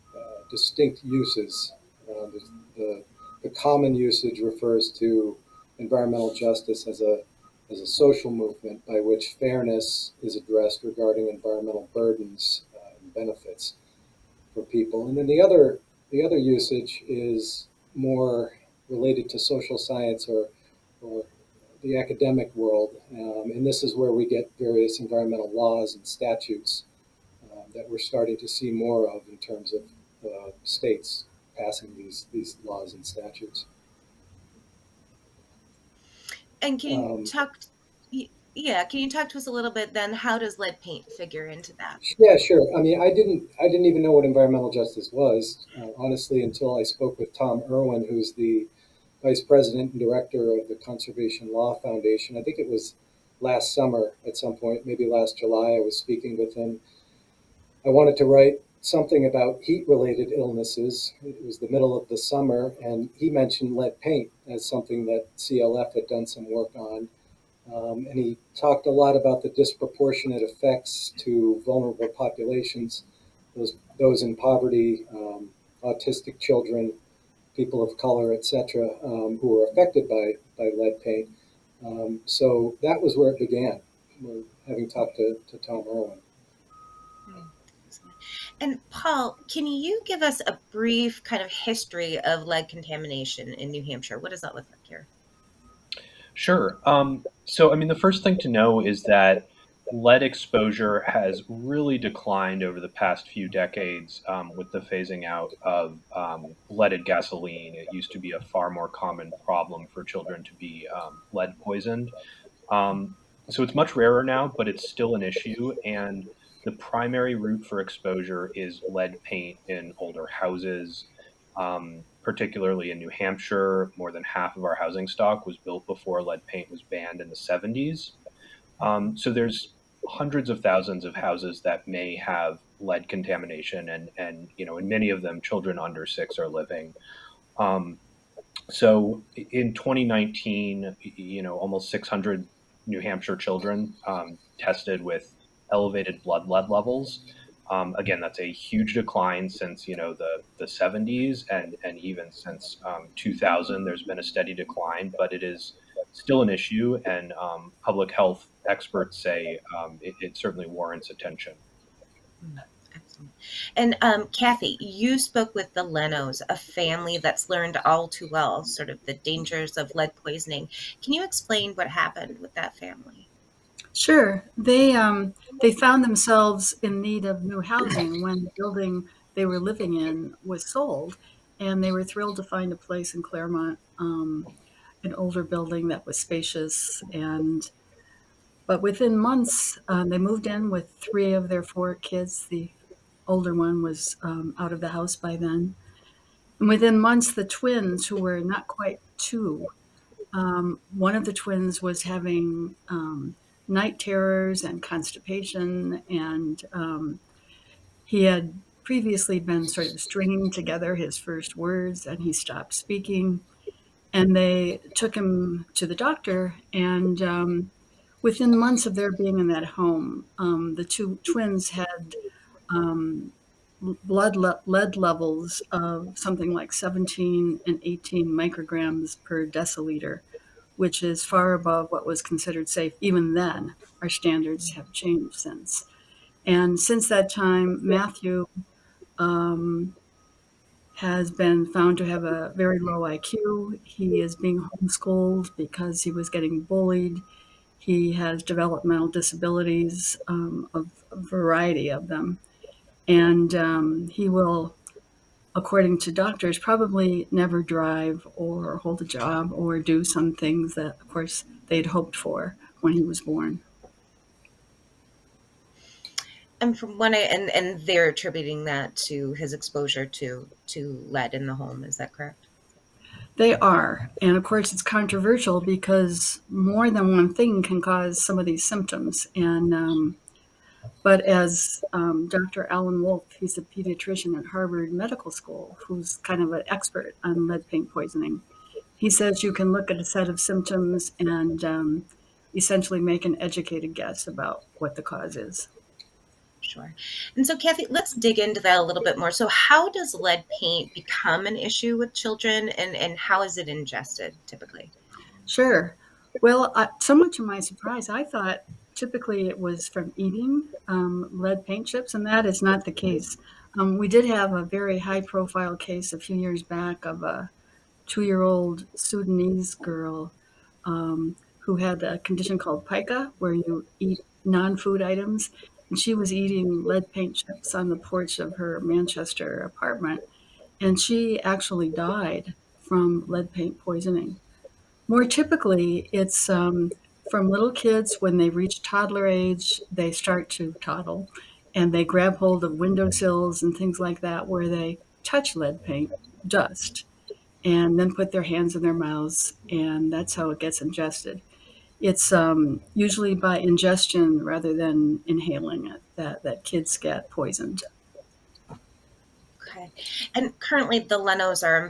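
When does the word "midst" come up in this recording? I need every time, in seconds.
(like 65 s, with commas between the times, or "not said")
not said.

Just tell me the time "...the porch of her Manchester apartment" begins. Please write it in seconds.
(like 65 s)
327 s.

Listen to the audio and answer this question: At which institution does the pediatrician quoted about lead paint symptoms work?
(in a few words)
Harvard Medical School.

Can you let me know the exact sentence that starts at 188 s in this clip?
But within months, um, they moved in with three of their four kids.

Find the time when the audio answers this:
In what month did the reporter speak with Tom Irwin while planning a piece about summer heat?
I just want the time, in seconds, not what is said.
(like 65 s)
55 s.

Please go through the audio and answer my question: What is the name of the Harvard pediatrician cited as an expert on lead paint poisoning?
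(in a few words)
Alan Woolf.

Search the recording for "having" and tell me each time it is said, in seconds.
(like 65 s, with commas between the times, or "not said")
84 s, 202 s.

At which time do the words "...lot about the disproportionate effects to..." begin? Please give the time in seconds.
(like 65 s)
68 s.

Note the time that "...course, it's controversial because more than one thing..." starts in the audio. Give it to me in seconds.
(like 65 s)
274 s.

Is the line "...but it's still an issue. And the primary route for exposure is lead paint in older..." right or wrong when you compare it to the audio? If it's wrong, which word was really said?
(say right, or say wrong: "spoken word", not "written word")
right.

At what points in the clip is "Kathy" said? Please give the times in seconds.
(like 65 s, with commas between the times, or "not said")
164 s, 297 s.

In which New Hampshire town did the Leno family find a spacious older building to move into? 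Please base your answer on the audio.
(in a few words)
Claremont.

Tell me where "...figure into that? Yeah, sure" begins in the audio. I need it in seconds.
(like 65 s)
41 s.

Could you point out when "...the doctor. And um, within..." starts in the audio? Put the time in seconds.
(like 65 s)
215 s.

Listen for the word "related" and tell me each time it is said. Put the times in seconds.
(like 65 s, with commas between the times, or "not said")
18 s, 59 s.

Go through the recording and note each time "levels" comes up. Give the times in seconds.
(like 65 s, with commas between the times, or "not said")
146 s, 224 s.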